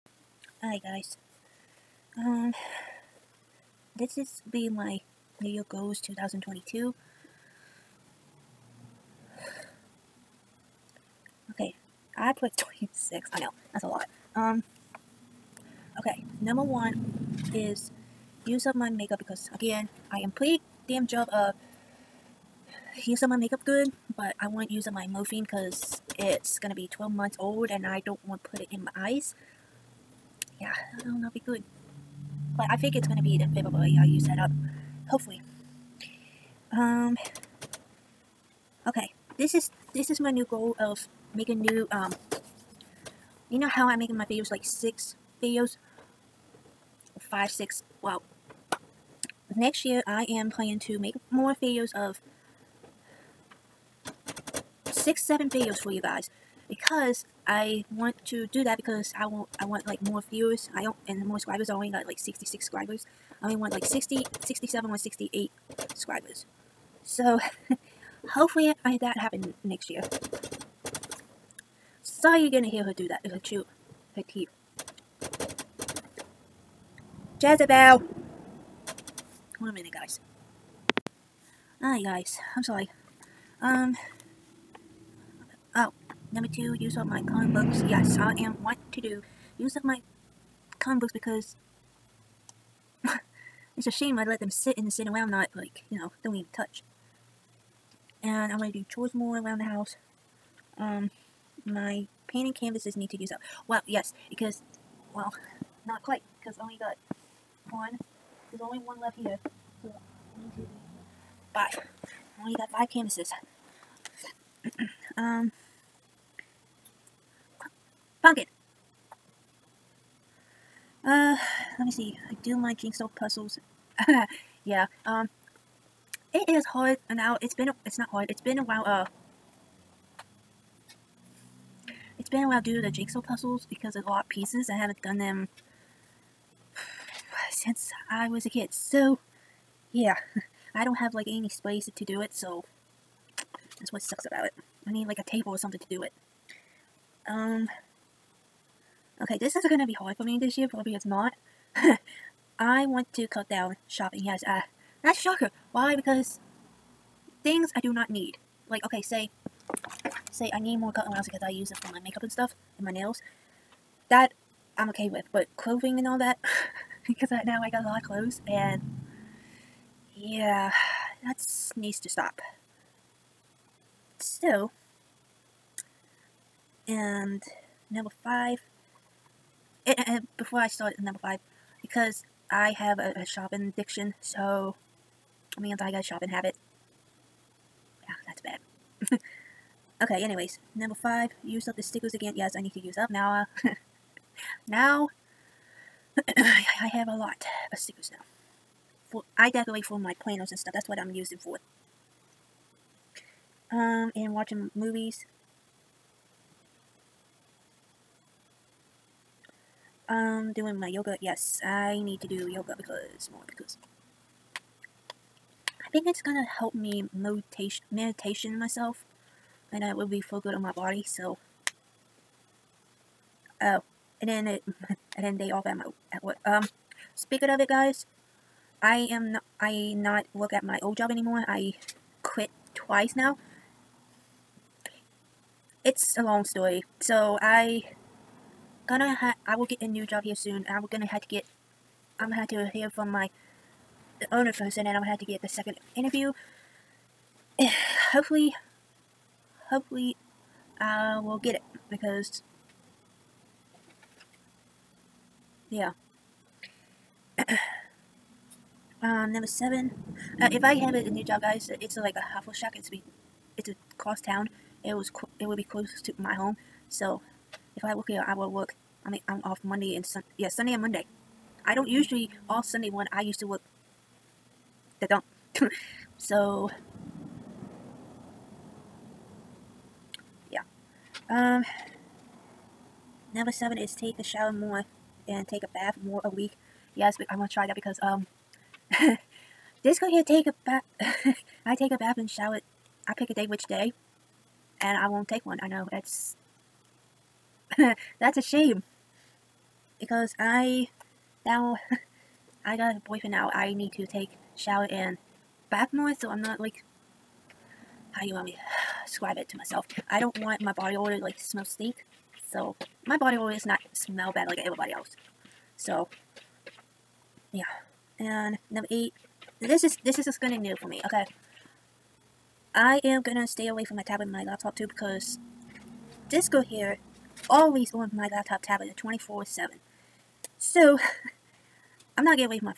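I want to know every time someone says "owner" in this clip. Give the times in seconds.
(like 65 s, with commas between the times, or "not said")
244 s.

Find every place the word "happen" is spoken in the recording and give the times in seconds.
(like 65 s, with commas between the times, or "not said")
69 s.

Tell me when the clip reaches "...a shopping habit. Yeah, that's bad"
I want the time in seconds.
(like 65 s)
186 s.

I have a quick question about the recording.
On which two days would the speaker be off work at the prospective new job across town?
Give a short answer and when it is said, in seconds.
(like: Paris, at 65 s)
Sunday and Monday, at 270 s.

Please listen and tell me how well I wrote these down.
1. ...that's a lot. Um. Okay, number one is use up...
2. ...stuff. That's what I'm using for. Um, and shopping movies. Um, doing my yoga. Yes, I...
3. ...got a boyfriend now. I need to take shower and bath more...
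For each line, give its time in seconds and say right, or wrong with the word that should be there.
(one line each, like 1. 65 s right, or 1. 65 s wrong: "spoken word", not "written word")
1. 13 s right
2. 200 s wrong: "watching", not "shopping"
3. 302 s right.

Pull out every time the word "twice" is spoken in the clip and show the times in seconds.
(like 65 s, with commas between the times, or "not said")
232 s.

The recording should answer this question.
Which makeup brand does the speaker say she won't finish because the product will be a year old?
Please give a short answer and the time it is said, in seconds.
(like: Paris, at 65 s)
Morphe, at 25 s.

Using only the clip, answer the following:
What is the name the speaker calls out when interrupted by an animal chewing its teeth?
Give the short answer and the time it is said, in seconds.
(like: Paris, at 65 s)
Jezebel, at 77 s.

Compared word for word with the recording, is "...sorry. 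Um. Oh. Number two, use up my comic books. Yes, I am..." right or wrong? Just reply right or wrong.
right.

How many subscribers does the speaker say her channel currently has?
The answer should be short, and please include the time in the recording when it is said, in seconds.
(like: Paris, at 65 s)
66, at 62 s.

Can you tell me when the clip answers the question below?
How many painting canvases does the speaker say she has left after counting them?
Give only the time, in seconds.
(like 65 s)
112 s.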